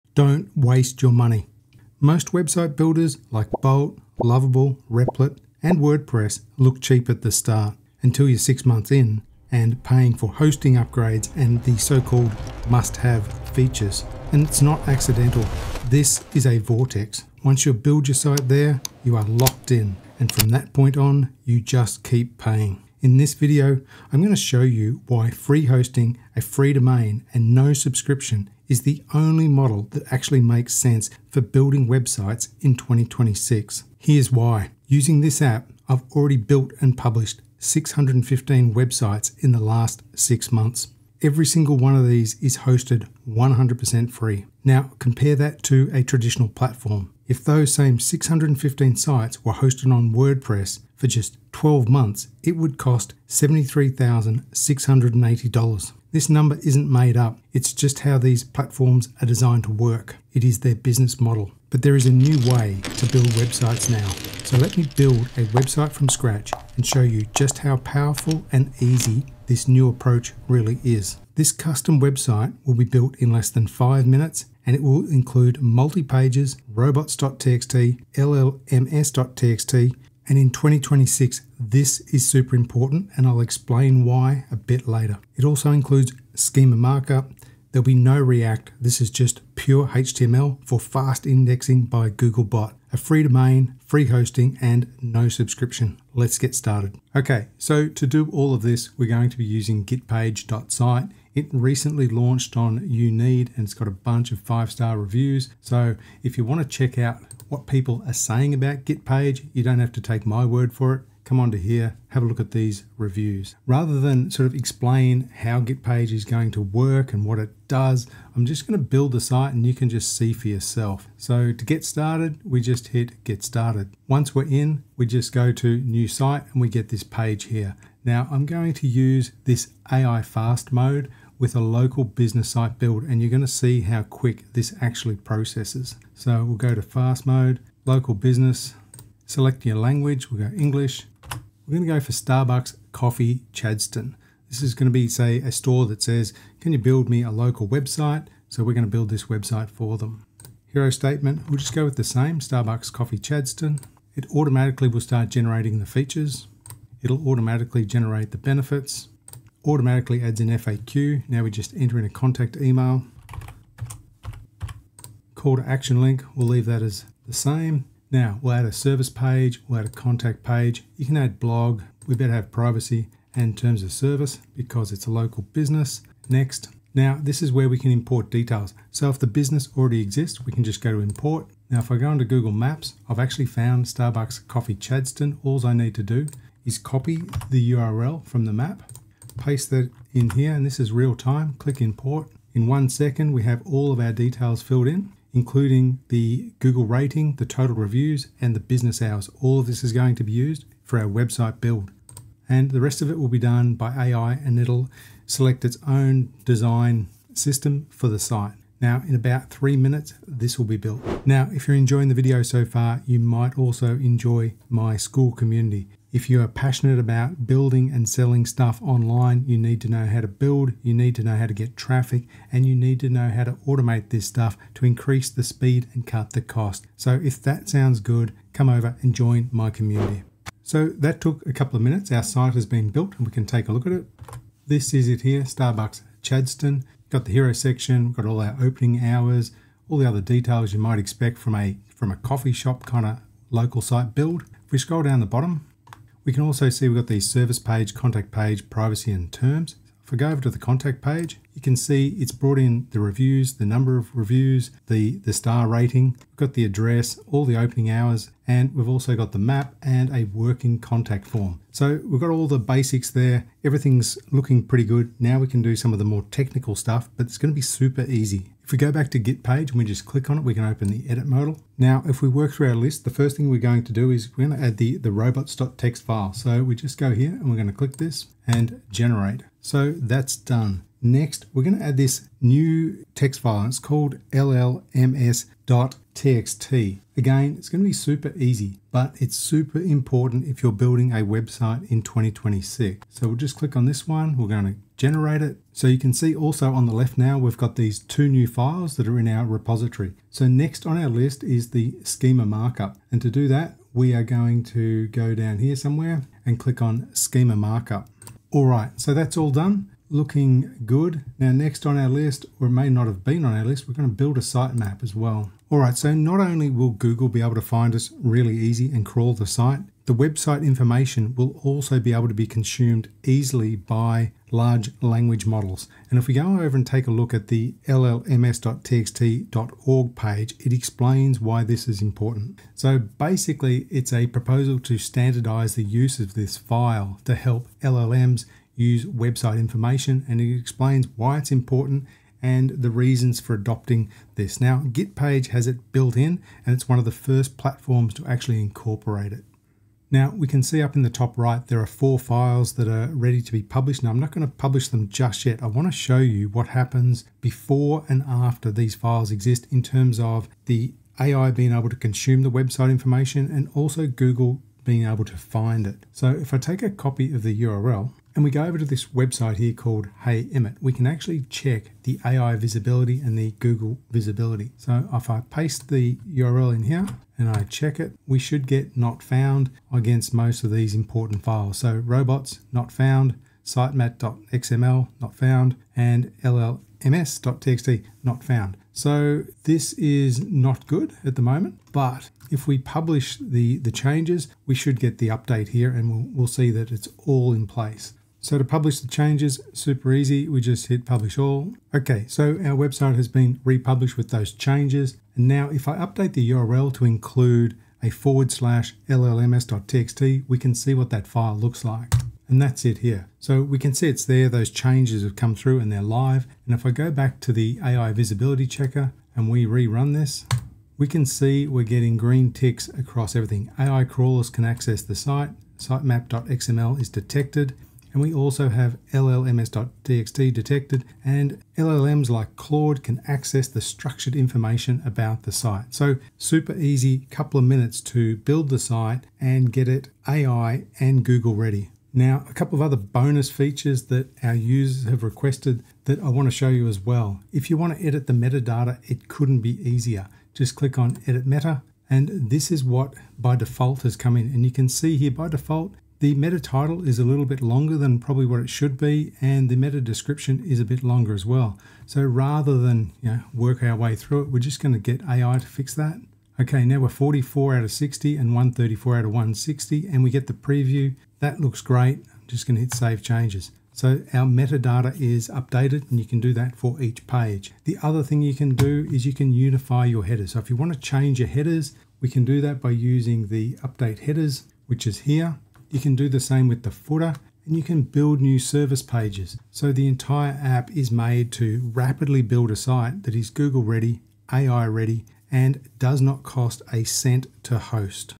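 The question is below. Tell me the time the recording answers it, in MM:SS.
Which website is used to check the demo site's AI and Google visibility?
06:10.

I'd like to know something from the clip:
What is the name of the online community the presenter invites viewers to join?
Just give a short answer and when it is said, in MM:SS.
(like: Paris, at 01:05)
Skool, at 03:34.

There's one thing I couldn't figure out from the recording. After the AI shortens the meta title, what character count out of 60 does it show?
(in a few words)
44.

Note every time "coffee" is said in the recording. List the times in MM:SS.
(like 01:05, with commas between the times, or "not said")
02:22, 02:32, 03:04, 04:02.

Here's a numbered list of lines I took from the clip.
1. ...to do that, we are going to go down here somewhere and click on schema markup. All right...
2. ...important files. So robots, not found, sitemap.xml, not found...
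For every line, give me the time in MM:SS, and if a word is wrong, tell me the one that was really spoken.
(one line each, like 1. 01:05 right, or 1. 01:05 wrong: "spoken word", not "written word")
1. 05:03 right
2. 06:20 right.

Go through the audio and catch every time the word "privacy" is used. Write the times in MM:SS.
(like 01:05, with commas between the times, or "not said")
02:52, 04:08.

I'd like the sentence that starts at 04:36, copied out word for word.
So we just go here and we're gonna click this and generate.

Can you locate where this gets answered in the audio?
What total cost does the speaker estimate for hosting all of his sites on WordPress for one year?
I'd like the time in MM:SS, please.
00:53.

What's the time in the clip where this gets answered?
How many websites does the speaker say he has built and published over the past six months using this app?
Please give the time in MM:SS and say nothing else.
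00:37.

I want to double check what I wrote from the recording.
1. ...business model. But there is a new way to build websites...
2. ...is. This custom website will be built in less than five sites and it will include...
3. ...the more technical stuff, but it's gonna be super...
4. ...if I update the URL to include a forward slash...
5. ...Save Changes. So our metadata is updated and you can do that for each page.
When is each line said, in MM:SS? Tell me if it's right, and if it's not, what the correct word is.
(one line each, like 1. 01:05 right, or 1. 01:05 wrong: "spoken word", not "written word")
1. 01:00 right
2. 01:10 wrong: "minutes", not "sites"
3. 04:25 right
4. 06:45 right
5. 07:52 right.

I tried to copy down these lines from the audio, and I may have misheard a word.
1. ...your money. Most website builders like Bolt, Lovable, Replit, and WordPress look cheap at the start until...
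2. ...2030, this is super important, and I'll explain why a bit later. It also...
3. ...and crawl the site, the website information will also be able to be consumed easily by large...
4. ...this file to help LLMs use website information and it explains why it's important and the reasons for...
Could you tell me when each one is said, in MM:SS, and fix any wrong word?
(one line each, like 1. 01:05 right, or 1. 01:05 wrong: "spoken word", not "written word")
1. 00:01 right
2. 01:20 wrong: "2026", not "2030"
3. 05:18 right
4. 05:36 right.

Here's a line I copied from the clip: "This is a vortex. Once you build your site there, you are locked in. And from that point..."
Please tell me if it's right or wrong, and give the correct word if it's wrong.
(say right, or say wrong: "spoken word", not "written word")
right.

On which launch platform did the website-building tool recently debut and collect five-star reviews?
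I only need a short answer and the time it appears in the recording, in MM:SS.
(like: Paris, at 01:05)
Uneed, at 01:42.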